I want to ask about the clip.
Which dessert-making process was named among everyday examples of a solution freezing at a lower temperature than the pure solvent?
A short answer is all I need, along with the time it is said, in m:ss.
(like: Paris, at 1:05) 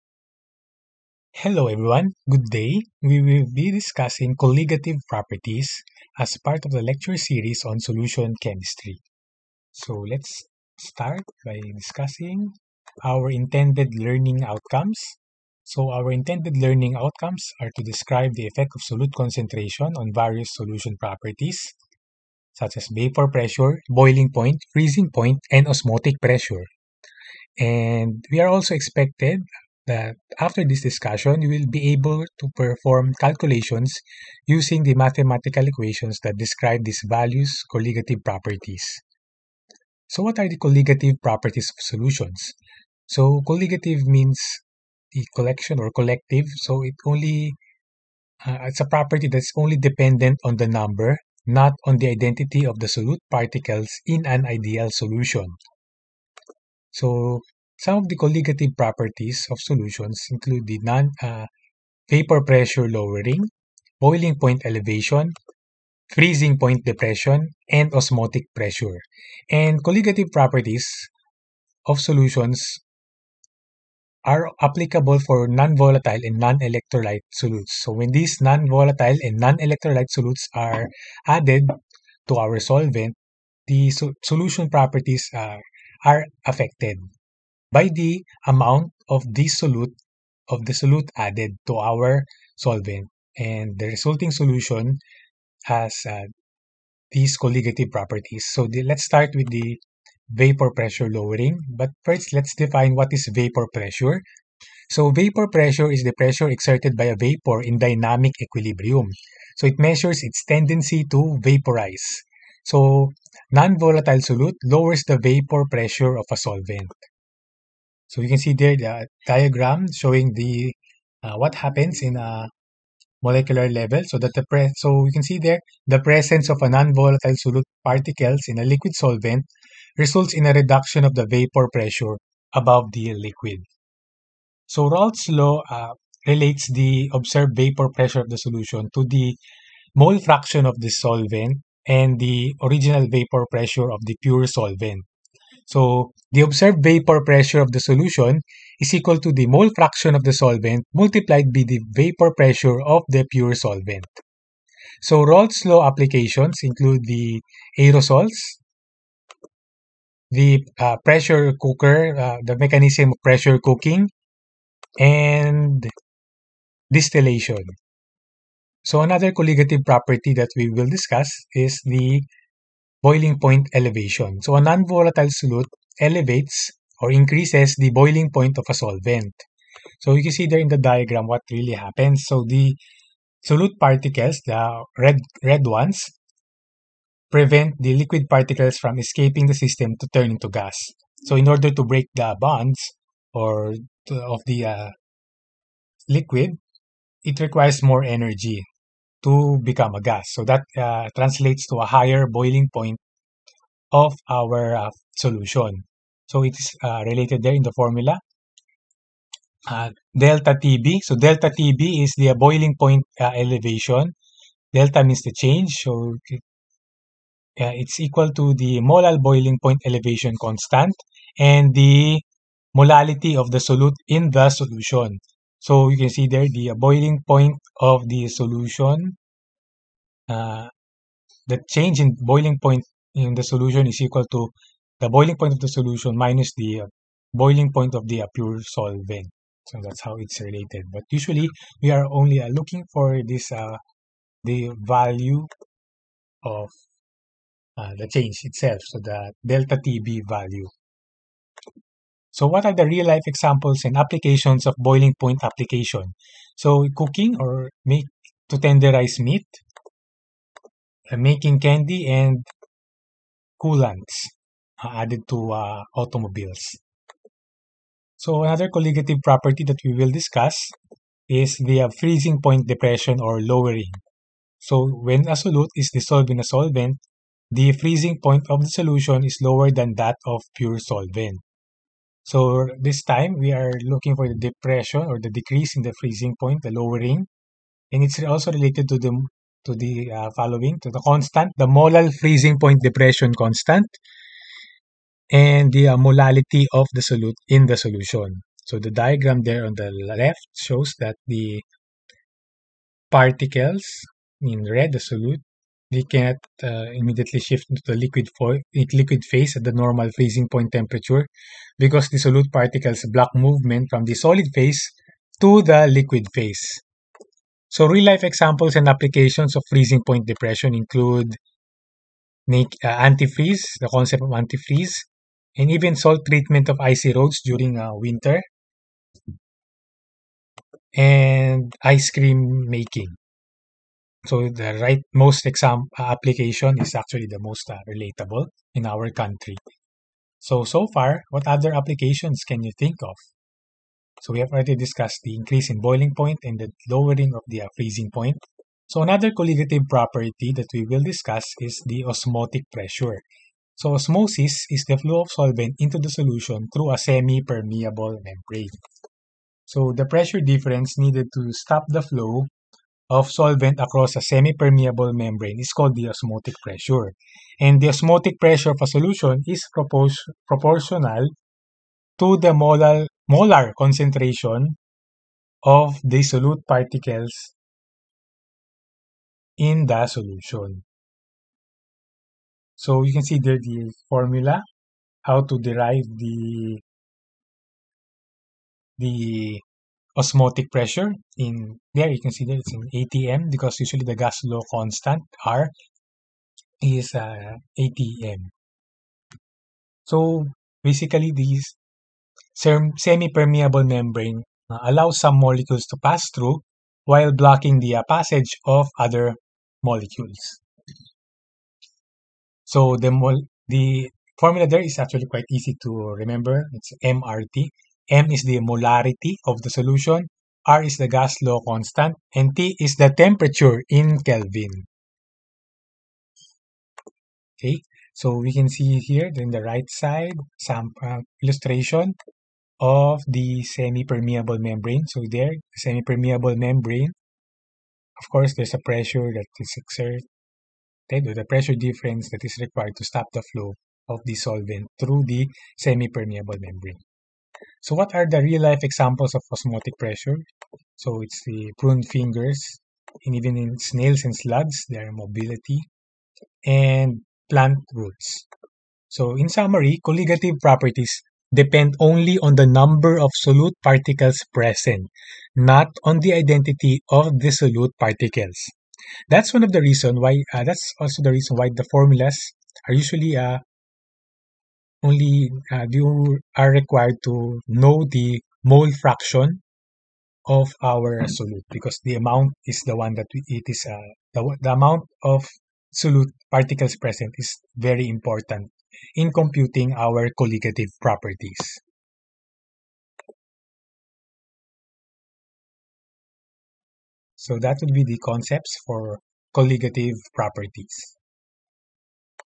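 Ice cream making, at 5:31.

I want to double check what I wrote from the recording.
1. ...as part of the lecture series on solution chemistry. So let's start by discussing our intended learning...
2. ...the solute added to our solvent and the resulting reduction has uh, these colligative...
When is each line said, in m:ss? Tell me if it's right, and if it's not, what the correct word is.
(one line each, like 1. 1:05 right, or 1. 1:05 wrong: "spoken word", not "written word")
1. 0:06 right
2. 1:30 wrong: "solution", not "reduction".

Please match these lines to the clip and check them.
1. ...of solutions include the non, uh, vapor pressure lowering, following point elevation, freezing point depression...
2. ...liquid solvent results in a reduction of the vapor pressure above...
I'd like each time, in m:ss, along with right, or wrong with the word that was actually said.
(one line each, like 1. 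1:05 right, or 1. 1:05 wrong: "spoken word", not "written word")
1. 0:59 wrong: "boiling", not "following"
2. 2:08 right.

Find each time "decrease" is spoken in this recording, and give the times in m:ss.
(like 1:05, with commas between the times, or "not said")
4:45.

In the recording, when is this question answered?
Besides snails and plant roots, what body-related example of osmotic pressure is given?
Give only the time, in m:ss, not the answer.
7:31.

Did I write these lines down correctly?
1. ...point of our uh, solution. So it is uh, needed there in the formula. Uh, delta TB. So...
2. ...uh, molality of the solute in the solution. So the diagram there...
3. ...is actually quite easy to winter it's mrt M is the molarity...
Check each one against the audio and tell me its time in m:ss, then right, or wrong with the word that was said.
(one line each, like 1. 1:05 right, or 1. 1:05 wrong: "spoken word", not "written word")
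1. 3:22 wrong: "related", not "needed"
2. 4:55 right
3. 6:54 wrong: "remember", not "winter".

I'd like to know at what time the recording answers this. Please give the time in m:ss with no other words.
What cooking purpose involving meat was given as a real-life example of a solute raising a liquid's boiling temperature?
4:18.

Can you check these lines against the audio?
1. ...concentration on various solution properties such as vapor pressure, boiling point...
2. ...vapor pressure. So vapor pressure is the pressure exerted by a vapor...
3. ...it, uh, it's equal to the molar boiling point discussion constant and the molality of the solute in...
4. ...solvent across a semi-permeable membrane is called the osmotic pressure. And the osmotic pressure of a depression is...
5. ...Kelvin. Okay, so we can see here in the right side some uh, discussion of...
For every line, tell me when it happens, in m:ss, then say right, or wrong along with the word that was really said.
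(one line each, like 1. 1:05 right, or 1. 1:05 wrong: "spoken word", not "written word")
1. 0:19 right
2. 1:43 right
3. 3:36 wrong: "elevation", not "discussion"
4. 6:03 wrong: "solution", not "depression"
5. 7:04 wrong: "illustration", not "discussion".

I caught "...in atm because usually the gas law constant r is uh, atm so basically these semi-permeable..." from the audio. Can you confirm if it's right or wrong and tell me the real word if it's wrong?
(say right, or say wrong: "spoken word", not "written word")
right.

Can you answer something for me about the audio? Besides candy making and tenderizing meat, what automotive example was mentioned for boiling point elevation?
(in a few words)
Coolants.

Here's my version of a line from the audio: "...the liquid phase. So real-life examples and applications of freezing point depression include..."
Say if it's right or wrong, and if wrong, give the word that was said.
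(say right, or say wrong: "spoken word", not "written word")
right.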